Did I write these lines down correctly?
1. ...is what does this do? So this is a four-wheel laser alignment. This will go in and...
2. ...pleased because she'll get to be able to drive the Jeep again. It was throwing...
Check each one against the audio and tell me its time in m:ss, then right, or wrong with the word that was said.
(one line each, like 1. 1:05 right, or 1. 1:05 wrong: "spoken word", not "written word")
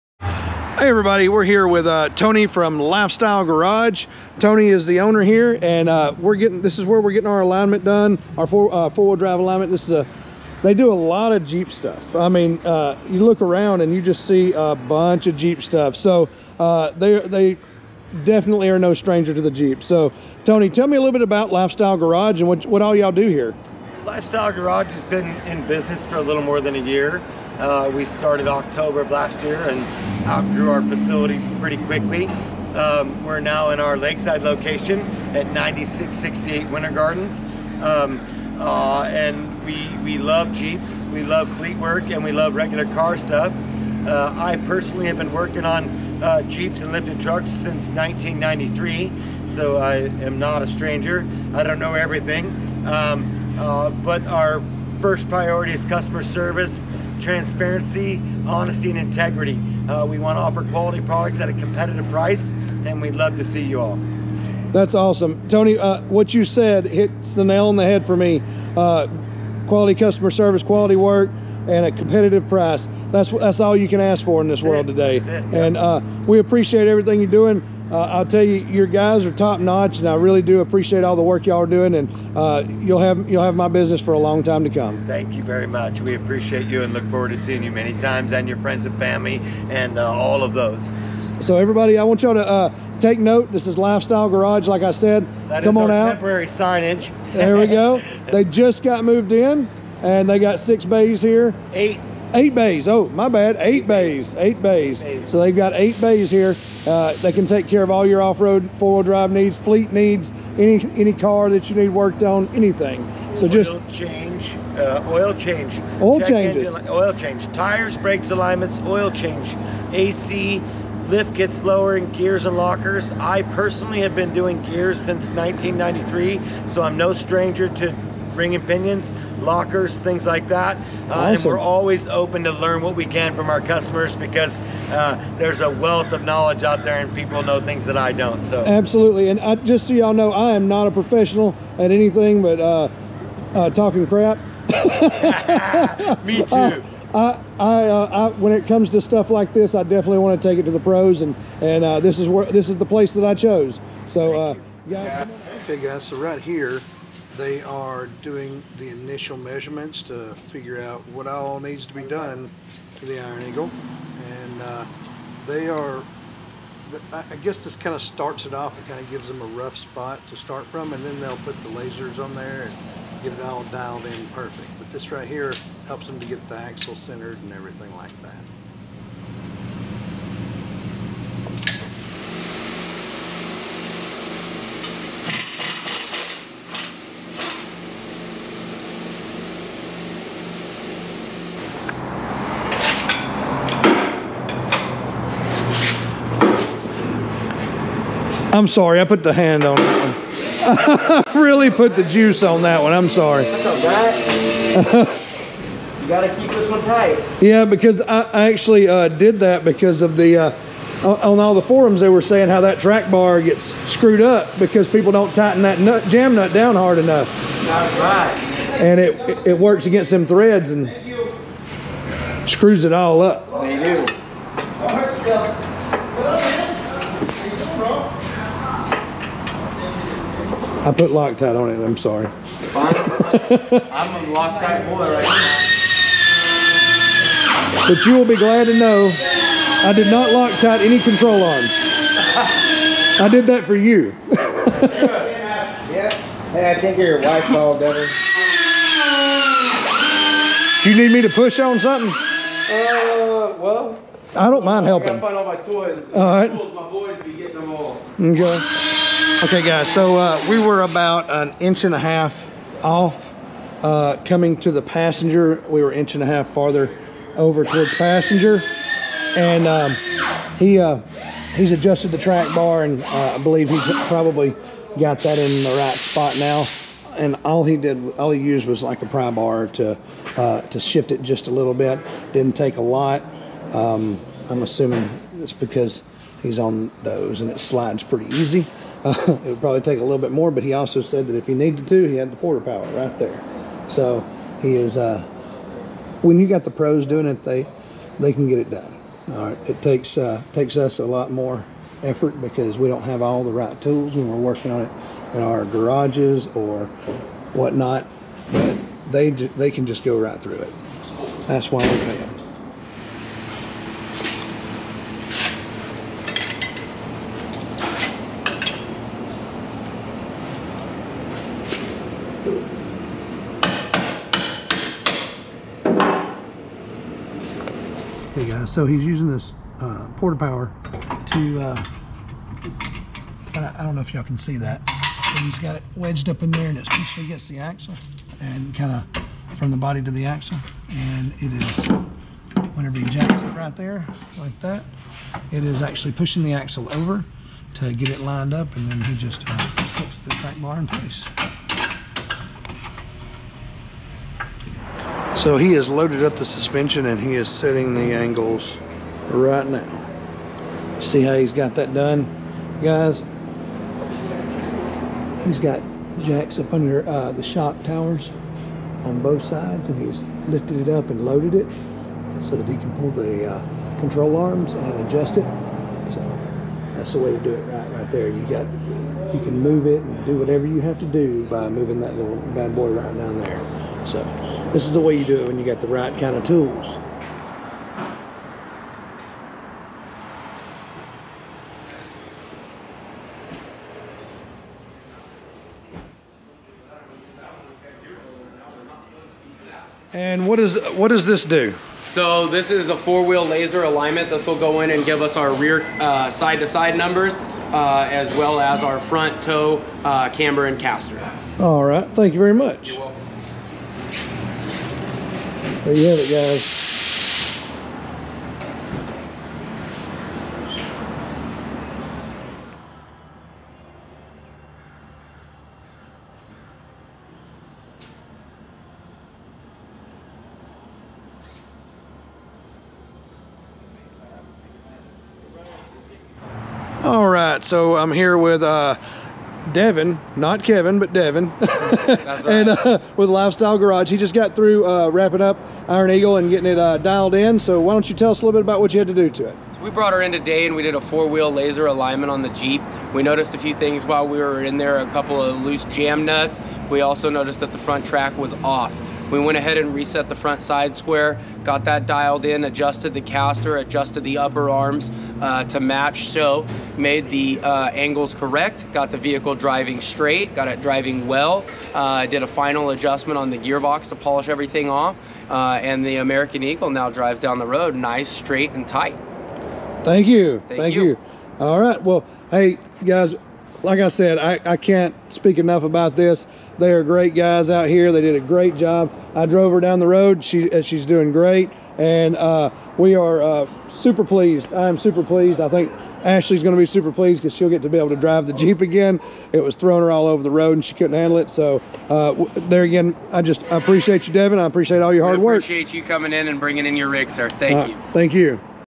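1. 6:40 right
2. 8:17 right.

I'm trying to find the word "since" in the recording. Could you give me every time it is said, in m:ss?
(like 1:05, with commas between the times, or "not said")
0:47, 2:04.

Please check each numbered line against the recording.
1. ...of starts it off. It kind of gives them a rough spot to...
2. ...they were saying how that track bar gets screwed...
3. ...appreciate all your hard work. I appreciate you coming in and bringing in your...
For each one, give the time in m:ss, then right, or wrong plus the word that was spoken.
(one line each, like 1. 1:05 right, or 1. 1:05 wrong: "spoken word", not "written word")
1. 2:47 right
2. 3:32 right
3. 8:24 right.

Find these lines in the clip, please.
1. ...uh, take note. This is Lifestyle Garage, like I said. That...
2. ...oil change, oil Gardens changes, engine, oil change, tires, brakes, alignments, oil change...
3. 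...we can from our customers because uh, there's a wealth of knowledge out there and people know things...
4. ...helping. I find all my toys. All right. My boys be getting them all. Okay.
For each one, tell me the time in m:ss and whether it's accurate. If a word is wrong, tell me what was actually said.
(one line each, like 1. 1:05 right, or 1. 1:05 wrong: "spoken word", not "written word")
1. 1:32 right
2. 1:55 wrong: "Check", not "Gardens"
3. 2:12 right
4. 4:14 right.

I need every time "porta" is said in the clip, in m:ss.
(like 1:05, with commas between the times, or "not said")
4:52, 5:30.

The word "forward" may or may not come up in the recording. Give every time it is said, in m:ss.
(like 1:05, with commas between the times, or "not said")
1:27.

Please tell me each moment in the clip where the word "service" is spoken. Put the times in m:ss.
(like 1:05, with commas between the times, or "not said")
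0:56, 1:10.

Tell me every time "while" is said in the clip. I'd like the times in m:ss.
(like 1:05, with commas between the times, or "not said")
7:34.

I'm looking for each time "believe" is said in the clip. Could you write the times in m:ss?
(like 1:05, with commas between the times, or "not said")
4:33.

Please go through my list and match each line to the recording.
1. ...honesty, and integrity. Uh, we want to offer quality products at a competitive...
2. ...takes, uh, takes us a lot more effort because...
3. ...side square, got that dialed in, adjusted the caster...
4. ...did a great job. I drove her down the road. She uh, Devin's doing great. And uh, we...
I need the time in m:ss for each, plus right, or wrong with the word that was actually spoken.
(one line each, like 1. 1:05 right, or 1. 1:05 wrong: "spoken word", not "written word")
1. 0:58 right
2. 4:59 right
3. 7:40 right
4. 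8:08 wrong: "She", not "Devin".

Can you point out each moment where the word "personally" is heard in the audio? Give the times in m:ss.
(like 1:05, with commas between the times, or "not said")
0:44, 2:03.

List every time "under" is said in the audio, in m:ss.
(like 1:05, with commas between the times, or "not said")
6:06.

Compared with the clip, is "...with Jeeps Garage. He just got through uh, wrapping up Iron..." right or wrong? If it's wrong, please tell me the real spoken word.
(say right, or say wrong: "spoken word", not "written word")
wrong: "Lifestyle", not "Jeeps".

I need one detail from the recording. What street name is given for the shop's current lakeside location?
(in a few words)
Winter Gardens.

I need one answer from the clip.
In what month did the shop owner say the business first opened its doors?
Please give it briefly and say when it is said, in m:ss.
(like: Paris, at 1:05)
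October, at 0:28.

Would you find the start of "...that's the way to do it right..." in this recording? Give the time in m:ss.
6:16.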